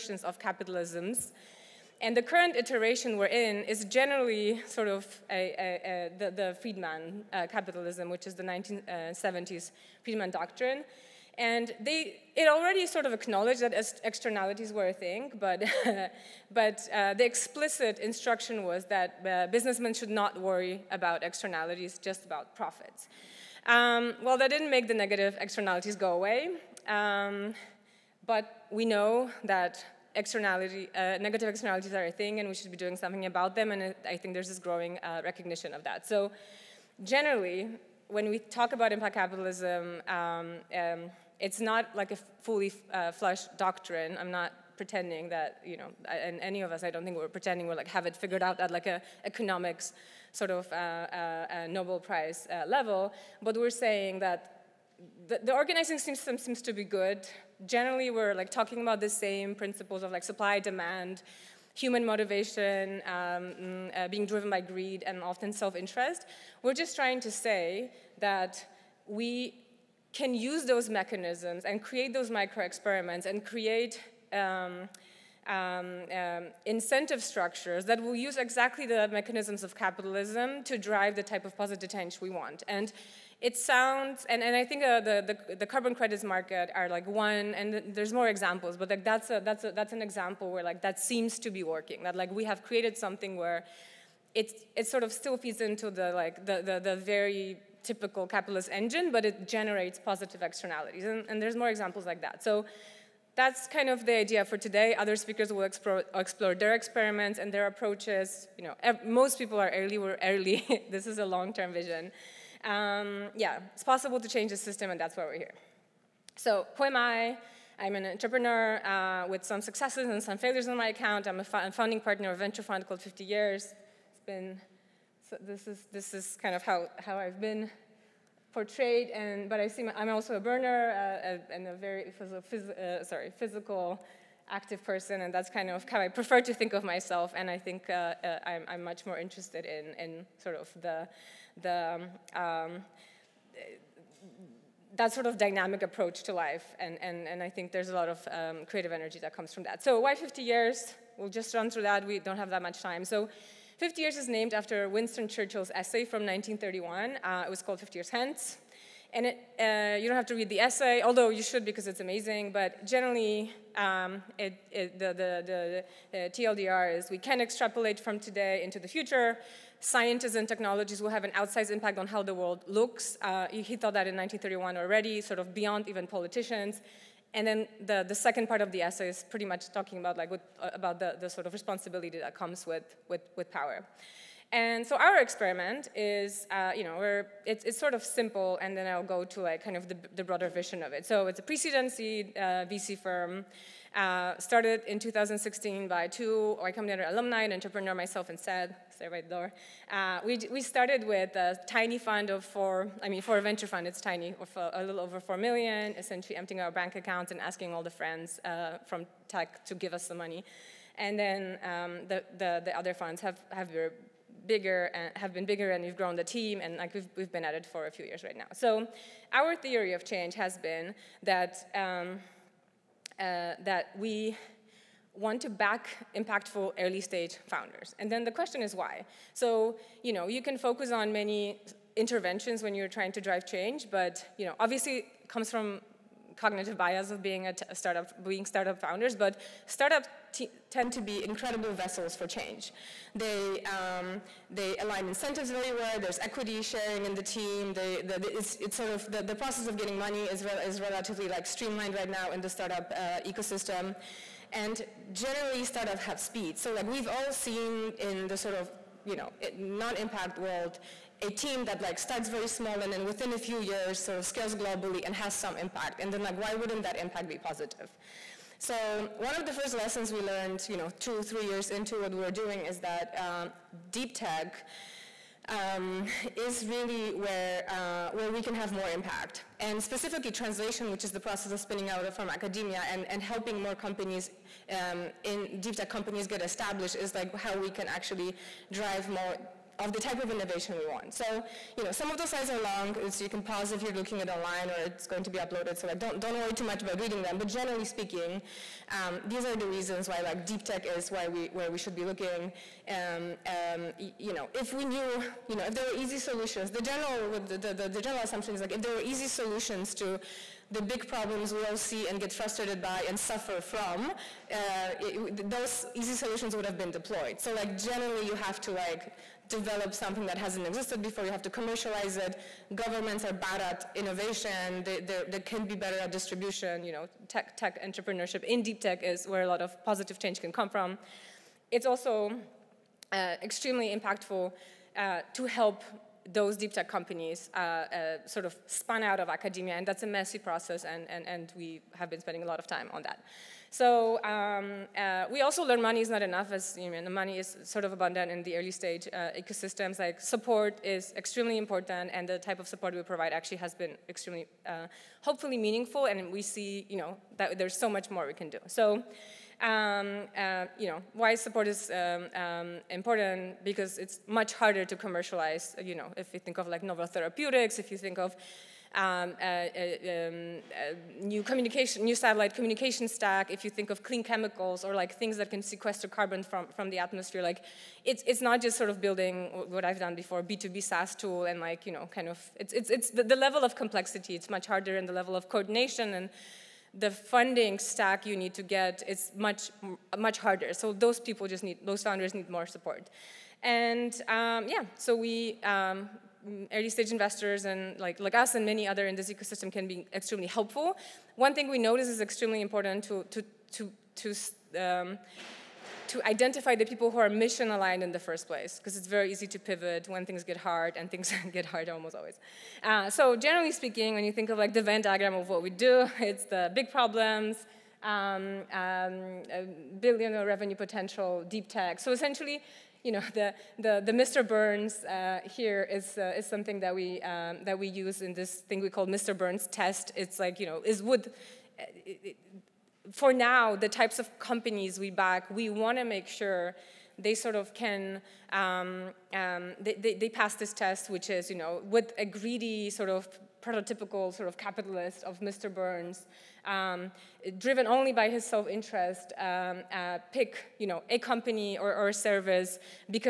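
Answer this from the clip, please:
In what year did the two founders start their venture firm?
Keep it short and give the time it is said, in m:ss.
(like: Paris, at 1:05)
2016, at 3:14.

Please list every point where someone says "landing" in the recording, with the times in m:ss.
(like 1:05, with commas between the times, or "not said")
not said.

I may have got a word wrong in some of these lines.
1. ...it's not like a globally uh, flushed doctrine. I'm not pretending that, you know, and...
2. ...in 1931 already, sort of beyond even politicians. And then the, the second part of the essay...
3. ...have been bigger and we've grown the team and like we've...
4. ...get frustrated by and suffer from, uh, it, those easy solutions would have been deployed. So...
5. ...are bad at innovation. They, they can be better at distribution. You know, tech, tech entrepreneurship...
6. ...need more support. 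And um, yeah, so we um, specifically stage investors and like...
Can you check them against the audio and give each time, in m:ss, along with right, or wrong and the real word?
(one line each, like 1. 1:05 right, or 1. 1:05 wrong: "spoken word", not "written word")
1. 0:41 wrong: "fully", not "globally"
2. 2:54 right
3. 3:35 right
4. 5:12 right
5. 5:23 right
6. 6:32 wrong: "early", not "specifically".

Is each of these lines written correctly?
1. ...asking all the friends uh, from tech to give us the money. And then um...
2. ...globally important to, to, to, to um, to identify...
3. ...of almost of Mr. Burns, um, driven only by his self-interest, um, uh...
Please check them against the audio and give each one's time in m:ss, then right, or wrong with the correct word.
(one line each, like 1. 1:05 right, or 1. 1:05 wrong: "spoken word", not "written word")
1. 3:27 right
2. 6:42 wrong: "extremely", not "globally"
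3. 7:24 wrong: "capitalist", not "almost".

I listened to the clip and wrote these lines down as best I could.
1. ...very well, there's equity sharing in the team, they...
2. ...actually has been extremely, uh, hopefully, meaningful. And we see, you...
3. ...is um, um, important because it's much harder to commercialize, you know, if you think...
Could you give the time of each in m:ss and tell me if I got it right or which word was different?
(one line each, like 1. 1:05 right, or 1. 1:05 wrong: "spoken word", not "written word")
1. 4:05 right
2. 5:53 right
3. 6:01 right.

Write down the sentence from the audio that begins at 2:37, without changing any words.
Uh, it was called 50 Years Hence.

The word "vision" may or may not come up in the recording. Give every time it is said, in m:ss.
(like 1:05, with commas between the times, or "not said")
1:51, 3:10.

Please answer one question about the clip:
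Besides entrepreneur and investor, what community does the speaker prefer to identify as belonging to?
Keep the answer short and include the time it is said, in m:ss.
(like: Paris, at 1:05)
burner, at 2:10.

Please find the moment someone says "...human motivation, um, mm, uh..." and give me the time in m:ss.
1:01.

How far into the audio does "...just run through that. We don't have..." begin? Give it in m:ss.
2:31.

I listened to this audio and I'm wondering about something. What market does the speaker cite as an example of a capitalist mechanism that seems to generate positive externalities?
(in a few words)
carbon credits market.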